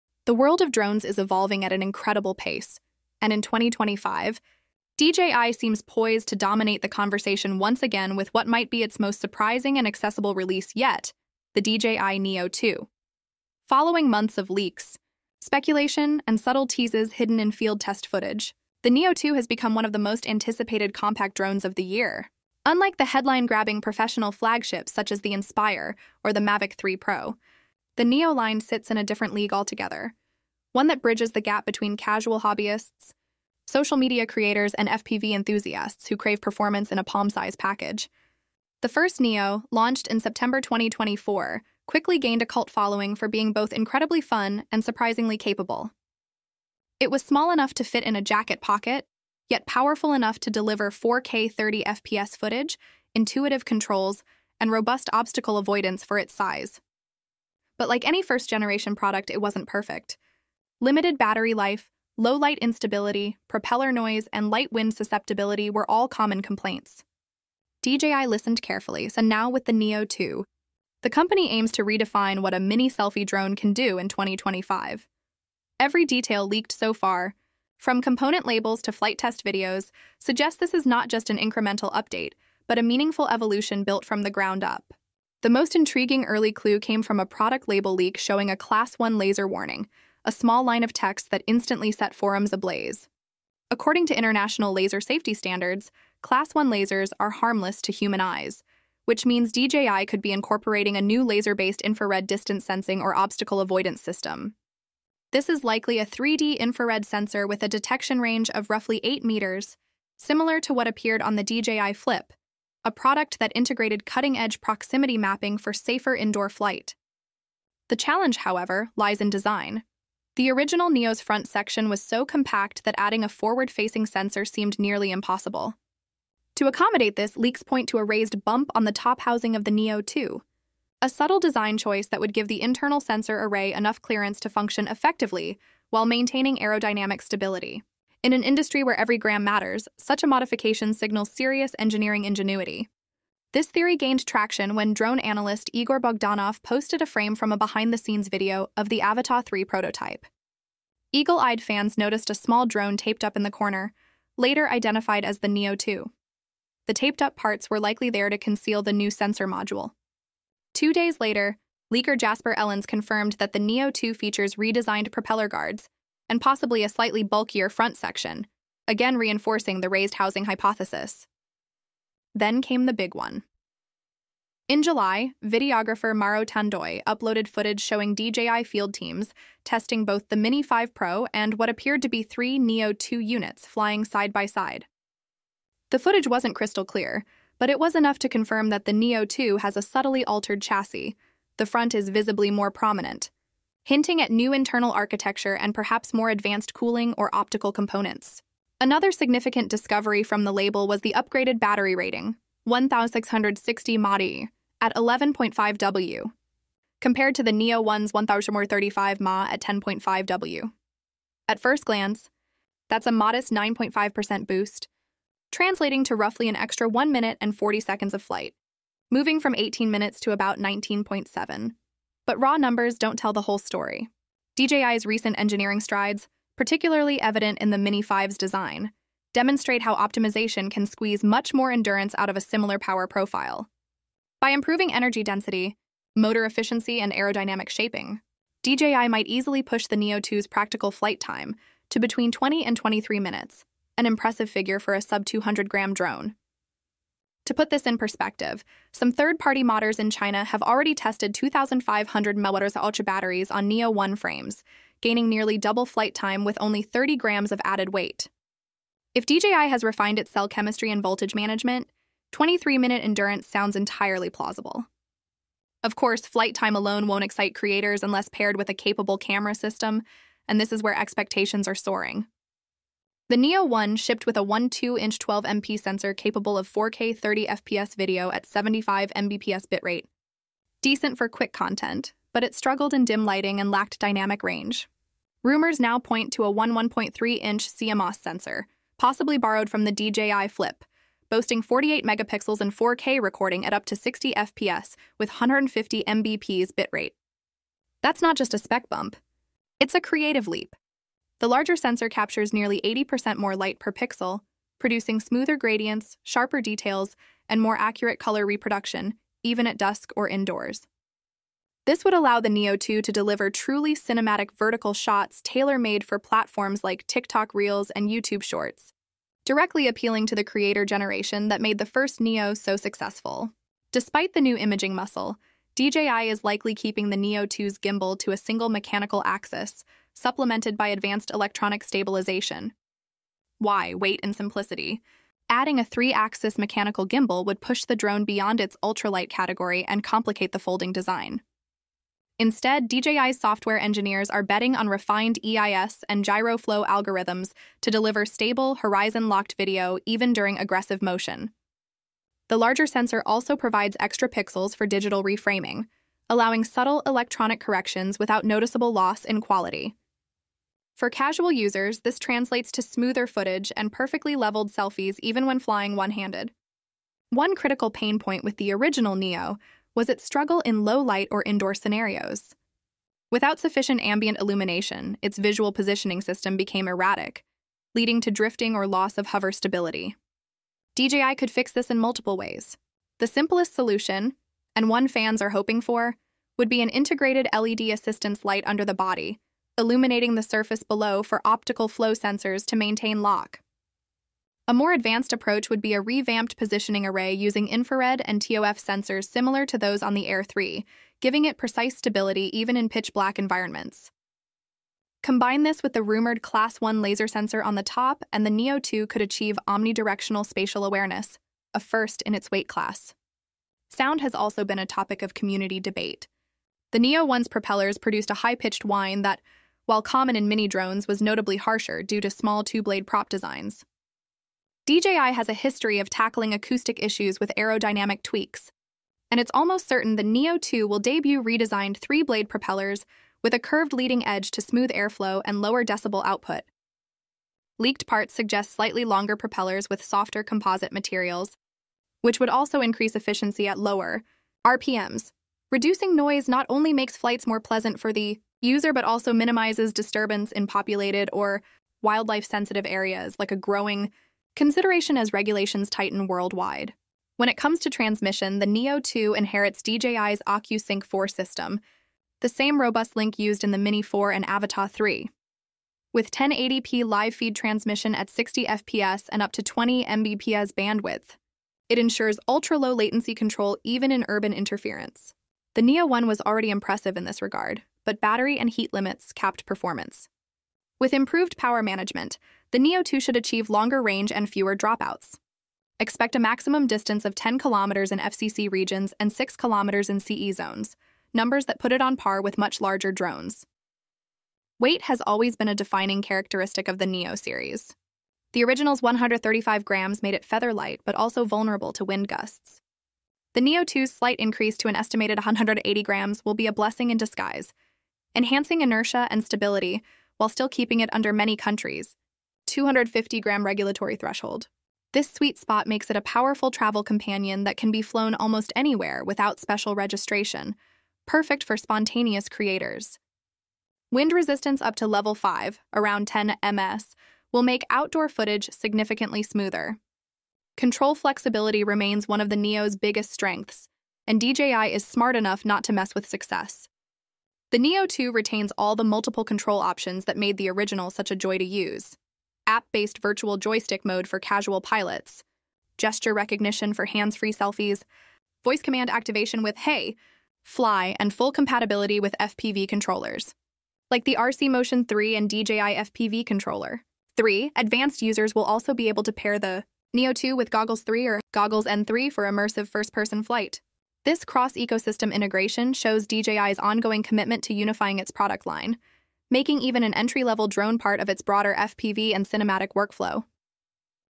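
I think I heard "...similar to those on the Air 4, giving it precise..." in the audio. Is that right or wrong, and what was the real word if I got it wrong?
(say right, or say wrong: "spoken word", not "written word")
wrong: "3", not "4".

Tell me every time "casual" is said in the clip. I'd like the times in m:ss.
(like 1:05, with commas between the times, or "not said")
0:31, 6:01, 9:04.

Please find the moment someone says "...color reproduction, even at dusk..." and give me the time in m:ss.
5:08.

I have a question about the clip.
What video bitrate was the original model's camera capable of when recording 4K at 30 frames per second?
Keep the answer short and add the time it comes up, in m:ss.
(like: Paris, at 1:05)
75 Mbps, at 4:38.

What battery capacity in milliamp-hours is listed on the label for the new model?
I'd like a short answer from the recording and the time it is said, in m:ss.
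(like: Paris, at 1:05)
1660 mAh, at 3:22.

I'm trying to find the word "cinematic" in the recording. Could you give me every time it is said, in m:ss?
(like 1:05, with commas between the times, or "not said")
5:13, 9:32.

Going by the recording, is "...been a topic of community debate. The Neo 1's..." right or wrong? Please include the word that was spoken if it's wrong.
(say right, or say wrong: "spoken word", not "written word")
right.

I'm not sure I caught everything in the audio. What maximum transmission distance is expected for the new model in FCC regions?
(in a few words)
10 kilometers.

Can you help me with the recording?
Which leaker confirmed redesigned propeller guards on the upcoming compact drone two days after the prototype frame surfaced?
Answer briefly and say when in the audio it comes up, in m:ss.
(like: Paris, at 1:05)
Jasper Ellens, at 2:42.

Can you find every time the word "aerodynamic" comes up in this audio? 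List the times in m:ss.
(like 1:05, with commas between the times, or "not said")
2:16, 3:57, 7:07.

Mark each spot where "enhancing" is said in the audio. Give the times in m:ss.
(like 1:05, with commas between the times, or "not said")
8:28.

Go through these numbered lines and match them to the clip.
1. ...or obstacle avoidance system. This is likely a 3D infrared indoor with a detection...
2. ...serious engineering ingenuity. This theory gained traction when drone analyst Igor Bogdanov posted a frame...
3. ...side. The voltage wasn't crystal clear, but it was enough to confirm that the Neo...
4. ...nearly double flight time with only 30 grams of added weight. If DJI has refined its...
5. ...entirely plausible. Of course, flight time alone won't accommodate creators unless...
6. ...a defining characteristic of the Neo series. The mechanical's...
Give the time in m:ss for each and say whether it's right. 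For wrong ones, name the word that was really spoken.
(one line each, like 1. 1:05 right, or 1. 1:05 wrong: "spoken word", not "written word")
1. 1:43 wrong: "sensor", not "indoor"
2. 2:21 right
3. 3:04 wrong: "footage", not "voltage"
4. 4:15 right
5. 4:23 wrong: "excite", not "accommodate"
6. 8:15 wrong: "original", not "mechanical".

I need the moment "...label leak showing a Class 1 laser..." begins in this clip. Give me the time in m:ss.
1:27.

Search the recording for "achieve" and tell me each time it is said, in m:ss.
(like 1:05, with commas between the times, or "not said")
6:49, 8:03.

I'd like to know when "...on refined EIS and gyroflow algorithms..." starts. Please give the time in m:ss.
5:44.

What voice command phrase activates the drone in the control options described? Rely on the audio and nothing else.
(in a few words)
Hey, Fly.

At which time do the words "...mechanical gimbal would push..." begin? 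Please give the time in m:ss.
5:36.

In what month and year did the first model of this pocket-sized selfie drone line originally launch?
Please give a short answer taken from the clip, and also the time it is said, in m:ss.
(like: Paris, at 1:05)
September 2024, at 0:40.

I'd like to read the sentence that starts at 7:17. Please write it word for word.
Leaked parts suggest slightly longer propellers with softer composite materials, which would also increase efficiency at lower RPMs.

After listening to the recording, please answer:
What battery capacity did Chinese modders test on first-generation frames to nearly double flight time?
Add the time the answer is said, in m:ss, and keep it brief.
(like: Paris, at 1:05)
2,500 mAh, at 4:11.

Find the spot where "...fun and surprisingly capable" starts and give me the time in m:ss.
0:44.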